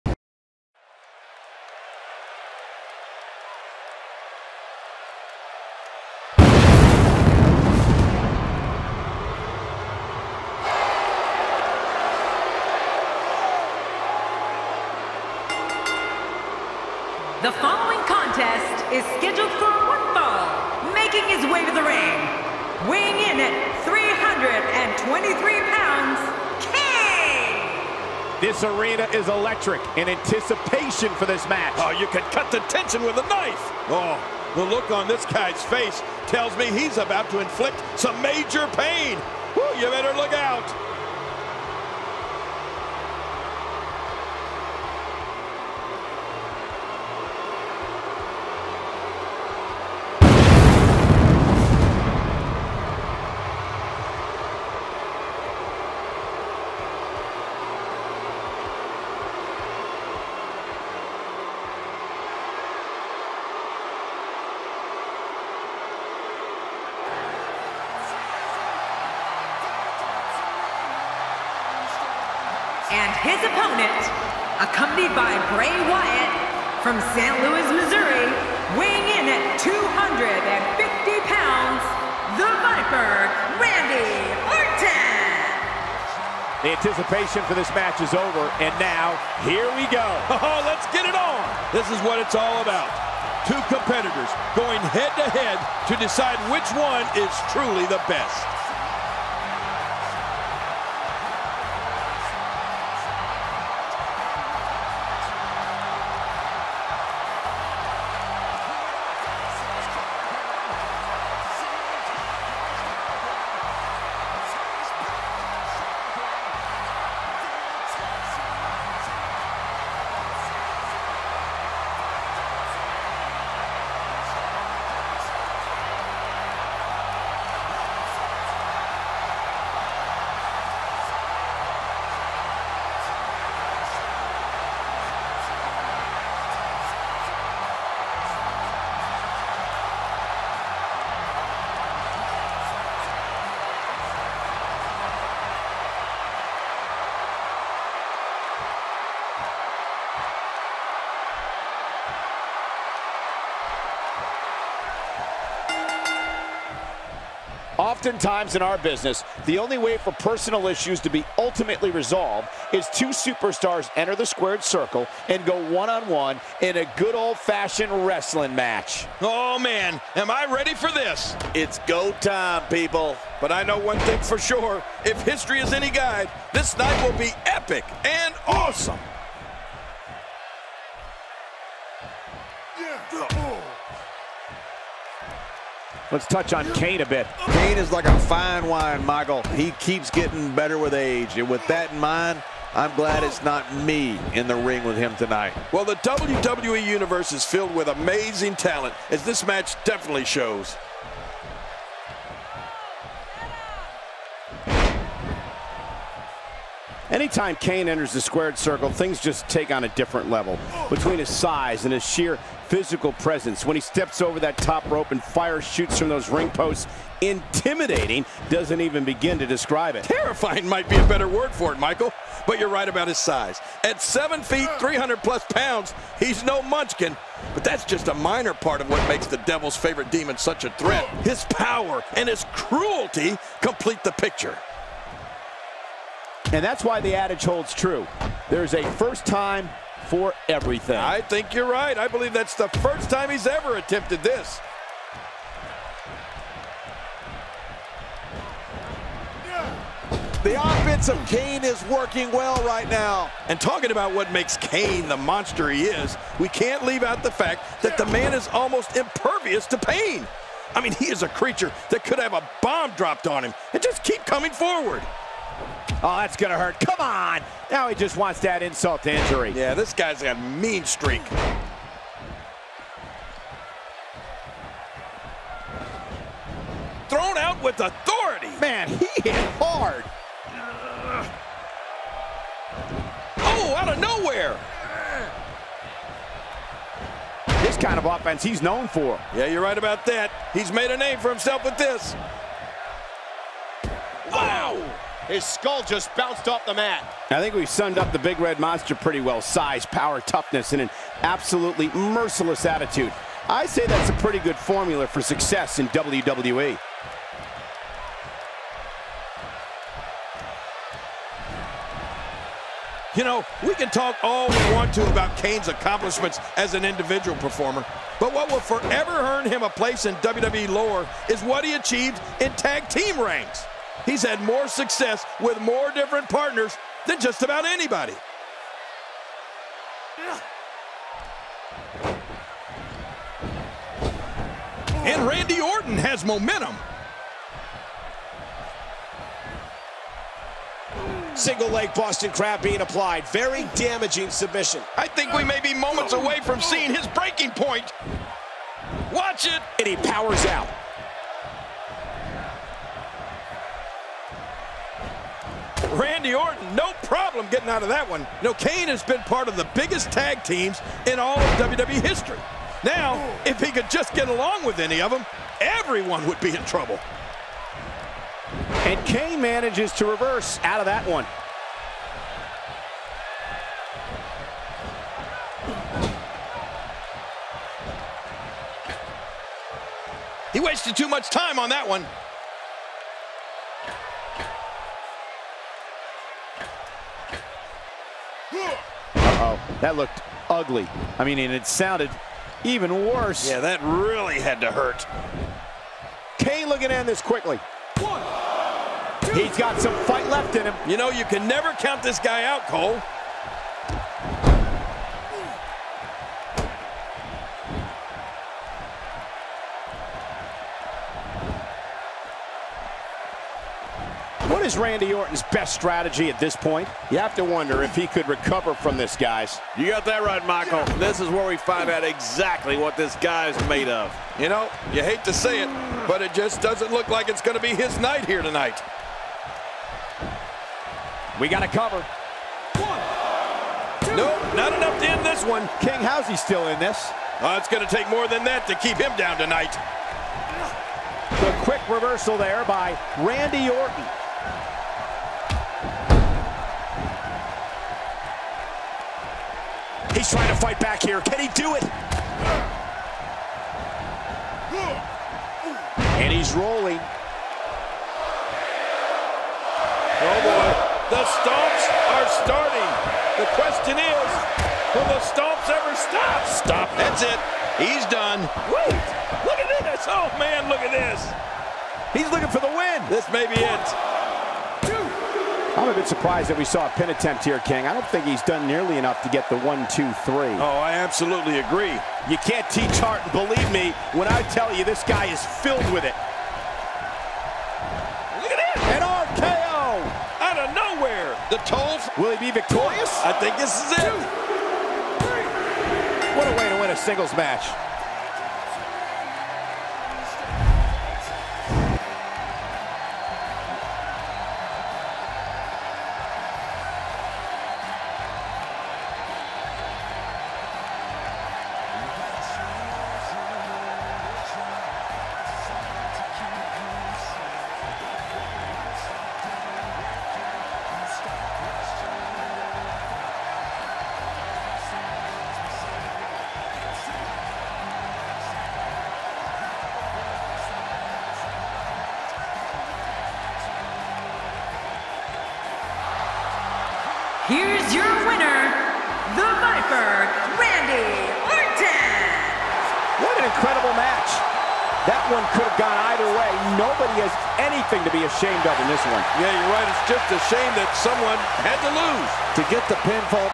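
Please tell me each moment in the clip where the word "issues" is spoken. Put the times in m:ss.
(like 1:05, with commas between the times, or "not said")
2:40.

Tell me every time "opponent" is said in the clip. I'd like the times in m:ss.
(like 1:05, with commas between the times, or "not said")
1:13.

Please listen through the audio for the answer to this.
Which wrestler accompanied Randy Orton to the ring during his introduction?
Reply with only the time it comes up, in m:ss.
1:15.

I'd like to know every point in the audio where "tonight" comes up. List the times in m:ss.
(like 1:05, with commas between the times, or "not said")
3:15, 7:08, 7:19.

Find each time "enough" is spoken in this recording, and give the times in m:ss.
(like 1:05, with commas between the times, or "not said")
7:14, 7:58.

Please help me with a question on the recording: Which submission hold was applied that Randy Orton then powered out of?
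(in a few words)
Single leg Boston Crab.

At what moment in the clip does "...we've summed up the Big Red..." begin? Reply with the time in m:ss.
4:57.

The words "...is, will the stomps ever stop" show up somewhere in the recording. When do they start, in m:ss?
7:43.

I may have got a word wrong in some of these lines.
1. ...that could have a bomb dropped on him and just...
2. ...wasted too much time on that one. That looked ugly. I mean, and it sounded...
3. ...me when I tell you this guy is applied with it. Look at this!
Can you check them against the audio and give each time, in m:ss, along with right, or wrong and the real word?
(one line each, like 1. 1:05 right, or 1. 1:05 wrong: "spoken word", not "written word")
1. 4:21 right
2. 6:20 right
3. 8:03 wrong: "filled", not "applied".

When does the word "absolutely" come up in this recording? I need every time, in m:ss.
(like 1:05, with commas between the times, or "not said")
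5:01, 8:00.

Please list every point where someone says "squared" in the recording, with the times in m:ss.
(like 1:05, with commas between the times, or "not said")
2:44, 3:28.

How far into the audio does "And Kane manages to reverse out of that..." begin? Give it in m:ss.
6:08.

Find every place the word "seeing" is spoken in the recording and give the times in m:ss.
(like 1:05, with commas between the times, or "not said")
5:46.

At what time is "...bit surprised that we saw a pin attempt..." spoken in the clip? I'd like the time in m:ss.
7:55.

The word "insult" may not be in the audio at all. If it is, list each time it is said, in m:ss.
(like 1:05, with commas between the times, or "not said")
4:28.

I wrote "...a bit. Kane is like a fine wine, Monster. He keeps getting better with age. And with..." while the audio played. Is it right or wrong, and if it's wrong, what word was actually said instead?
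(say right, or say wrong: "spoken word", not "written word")
wrong: "Michael", not "Monster".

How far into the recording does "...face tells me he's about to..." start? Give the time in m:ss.
0:35.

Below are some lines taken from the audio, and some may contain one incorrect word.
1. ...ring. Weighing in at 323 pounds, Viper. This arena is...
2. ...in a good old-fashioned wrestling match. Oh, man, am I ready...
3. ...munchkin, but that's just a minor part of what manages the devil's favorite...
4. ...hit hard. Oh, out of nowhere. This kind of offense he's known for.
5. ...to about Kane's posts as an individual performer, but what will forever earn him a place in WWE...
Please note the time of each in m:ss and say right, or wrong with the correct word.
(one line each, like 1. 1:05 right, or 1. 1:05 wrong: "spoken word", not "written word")
1. 0:21 wrong: "Kane", not "Viper"
2. 2:46 right
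3. 3:46 wrong: "makes", not "manages"
4. 4:39 right
5. 5:14 wrong: "accomplishments", not "posts".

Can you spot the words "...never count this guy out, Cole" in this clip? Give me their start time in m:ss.
6:41.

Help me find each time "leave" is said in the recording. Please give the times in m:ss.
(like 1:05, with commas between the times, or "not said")
4:16.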